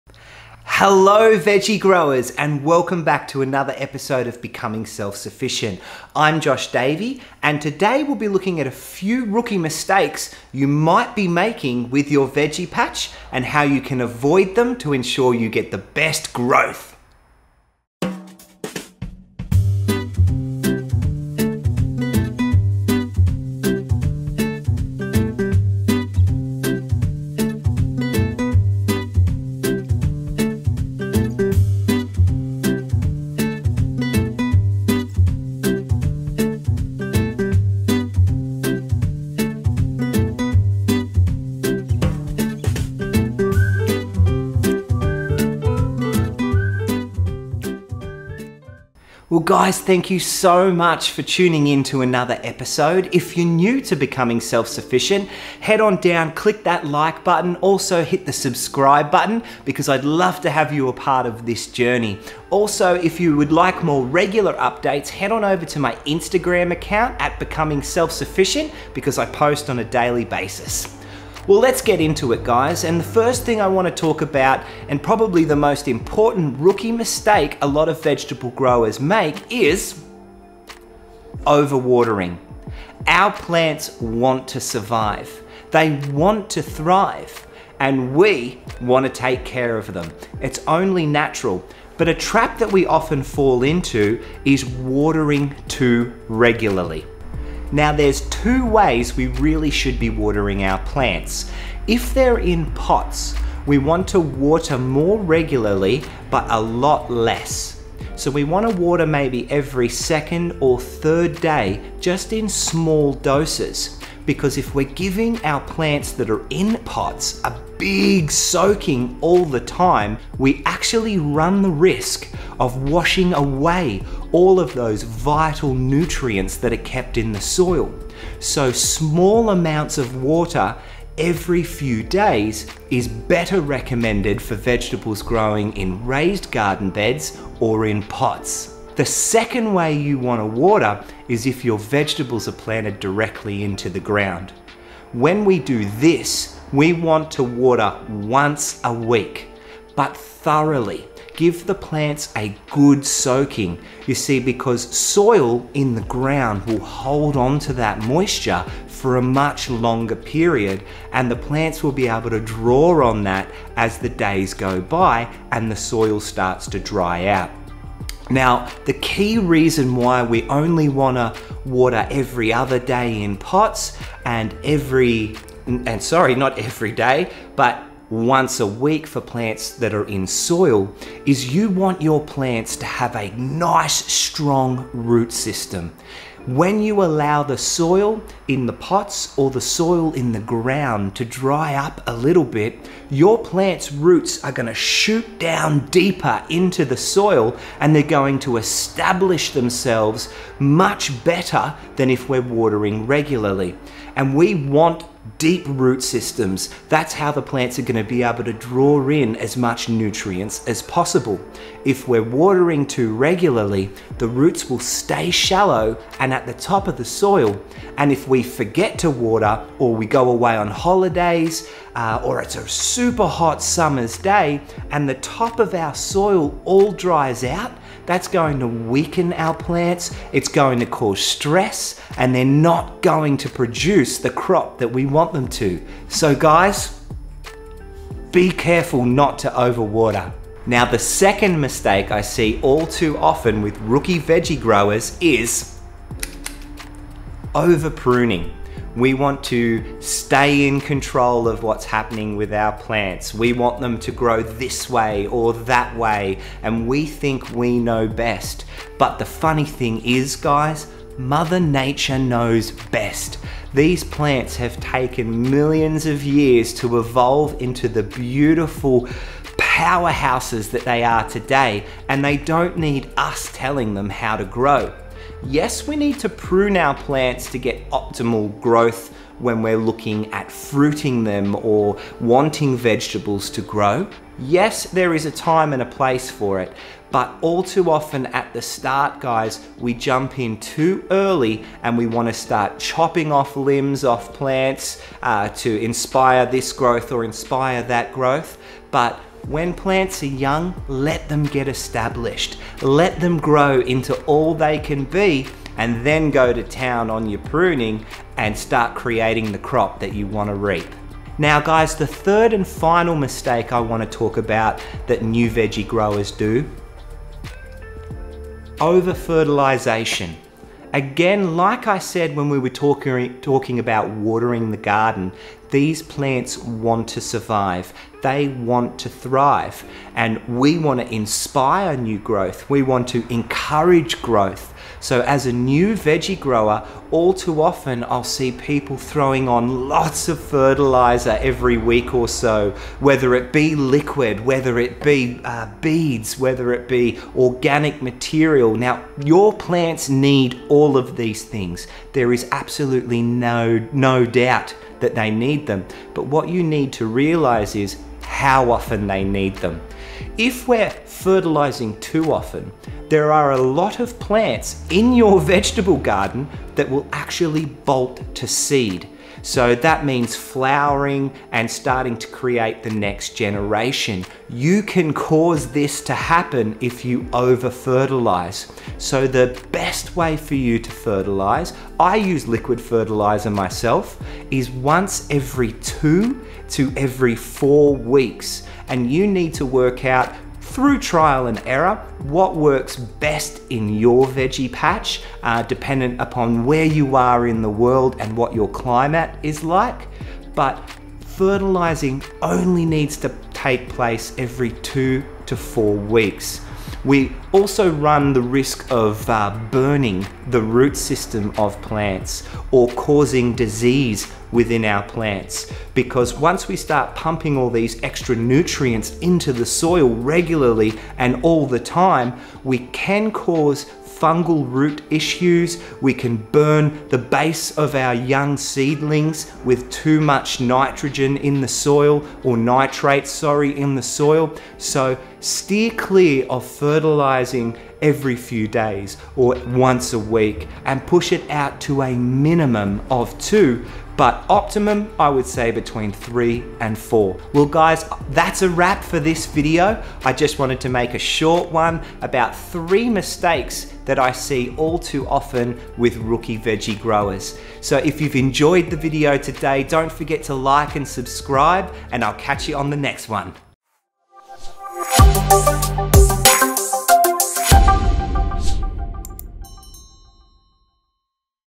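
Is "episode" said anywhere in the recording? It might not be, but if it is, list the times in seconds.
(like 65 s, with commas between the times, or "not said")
3 s, 52 s.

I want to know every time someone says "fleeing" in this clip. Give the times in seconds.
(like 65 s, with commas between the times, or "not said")
not said.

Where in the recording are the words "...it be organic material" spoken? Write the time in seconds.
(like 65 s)
346 s.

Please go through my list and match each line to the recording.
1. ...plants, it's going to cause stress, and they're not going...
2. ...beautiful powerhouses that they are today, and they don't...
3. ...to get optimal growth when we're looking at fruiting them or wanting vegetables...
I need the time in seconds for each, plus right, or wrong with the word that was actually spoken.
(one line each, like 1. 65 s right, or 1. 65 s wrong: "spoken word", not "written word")
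1. 229 s right
2. 268 s right
3. 277 s right.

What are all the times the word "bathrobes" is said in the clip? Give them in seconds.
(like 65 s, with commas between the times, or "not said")
not said.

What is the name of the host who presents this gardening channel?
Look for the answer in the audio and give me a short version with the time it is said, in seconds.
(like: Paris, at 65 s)
Josh Davey, at 6 s.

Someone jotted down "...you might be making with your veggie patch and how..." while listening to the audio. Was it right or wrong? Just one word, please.
right.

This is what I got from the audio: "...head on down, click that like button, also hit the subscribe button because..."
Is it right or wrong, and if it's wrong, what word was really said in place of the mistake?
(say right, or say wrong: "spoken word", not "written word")
right.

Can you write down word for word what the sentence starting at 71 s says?
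Well, let's get into it, guys.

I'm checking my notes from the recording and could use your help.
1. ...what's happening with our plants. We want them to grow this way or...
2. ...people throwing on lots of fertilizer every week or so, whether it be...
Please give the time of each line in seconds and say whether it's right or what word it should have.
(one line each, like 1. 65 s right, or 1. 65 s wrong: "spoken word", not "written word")
1. 251 s right
2. 338 s right.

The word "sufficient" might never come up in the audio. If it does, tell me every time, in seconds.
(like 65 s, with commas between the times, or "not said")
5 s, 54 s, 68 s.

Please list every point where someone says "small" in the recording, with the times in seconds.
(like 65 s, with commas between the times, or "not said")
112 s, 128 s.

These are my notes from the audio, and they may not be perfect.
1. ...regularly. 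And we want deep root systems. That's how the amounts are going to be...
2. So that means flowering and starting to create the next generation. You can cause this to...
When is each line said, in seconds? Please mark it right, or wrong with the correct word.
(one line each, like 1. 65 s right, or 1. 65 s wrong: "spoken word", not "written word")
1. 203 s wrong: "plants", not "amounts"
2. 369 s right.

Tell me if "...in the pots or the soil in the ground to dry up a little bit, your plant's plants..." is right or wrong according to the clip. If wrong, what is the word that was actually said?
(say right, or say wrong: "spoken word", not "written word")
wrong: "roots", not "plants".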